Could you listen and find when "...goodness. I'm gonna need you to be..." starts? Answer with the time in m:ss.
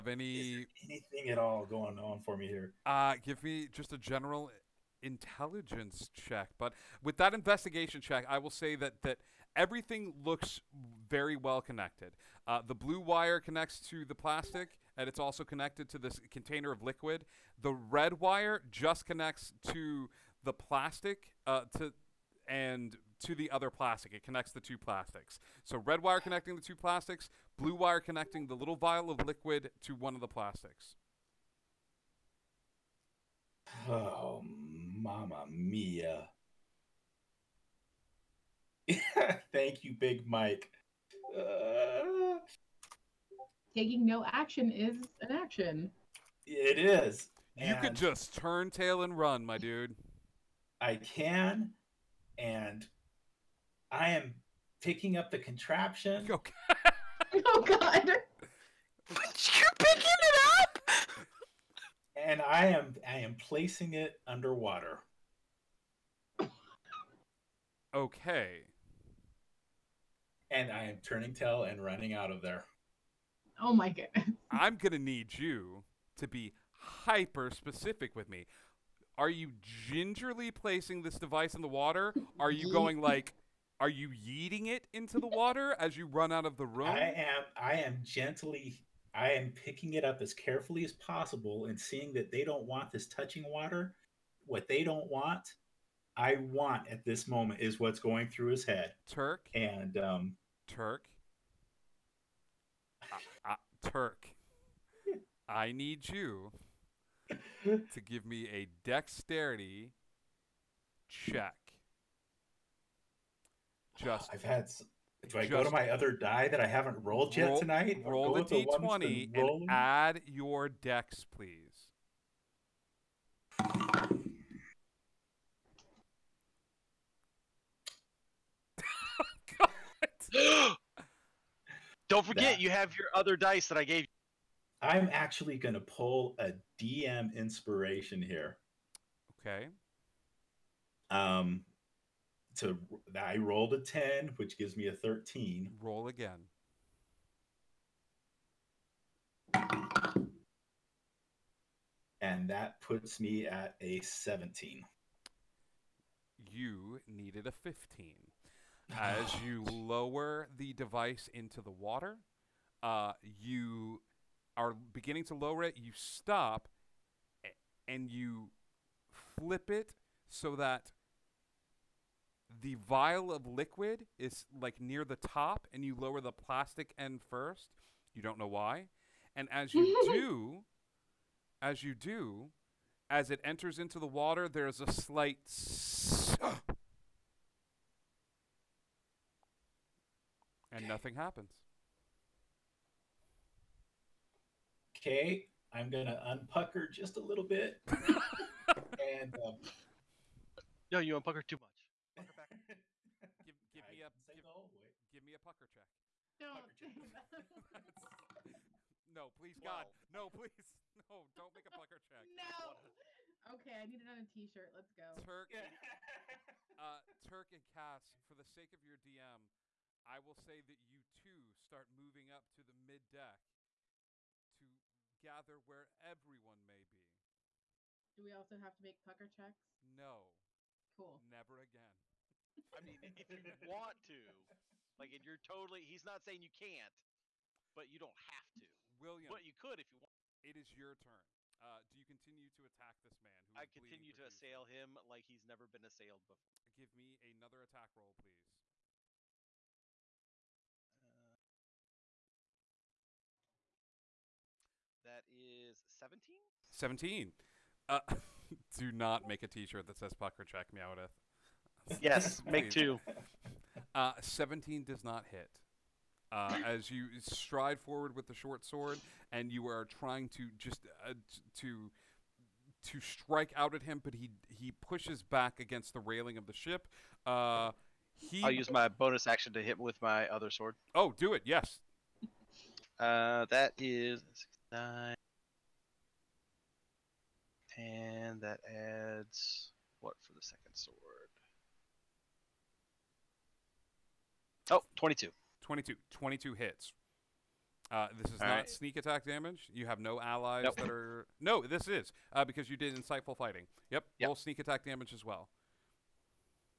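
1:13.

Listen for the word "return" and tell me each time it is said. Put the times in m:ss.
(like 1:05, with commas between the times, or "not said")
not said.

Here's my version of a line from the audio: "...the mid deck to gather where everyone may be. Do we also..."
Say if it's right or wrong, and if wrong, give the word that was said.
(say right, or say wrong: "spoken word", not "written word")
right.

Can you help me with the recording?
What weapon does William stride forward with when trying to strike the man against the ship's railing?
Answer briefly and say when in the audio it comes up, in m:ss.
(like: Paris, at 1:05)
short sword, at 4:28.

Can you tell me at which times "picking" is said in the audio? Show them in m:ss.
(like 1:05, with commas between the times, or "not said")
0:54, 0:59, 1:29.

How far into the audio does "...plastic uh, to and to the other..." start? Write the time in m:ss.
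0:20.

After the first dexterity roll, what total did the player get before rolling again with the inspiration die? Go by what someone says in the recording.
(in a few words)
13.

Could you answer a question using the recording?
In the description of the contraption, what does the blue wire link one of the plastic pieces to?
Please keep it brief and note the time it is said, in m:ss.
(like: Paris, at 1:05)
container of liquid, at 0:16.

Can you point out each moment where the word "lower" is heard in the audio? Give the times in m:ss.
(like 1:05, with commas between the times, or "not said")
2:39, 2:45, 2:55.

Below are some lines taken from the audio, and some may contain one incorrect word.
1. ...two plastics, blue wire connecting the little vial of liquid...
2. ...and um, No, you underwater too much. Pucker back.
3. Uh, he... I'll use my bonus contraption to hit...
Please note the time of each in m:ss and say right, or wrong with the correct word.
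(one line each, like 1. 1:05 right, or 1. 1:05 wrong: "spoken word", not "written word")
1. 0:26 right
2. 3:17 wrong: "unpucker", not "underwater"
3. 4:37 wrong: "action", not "contraption".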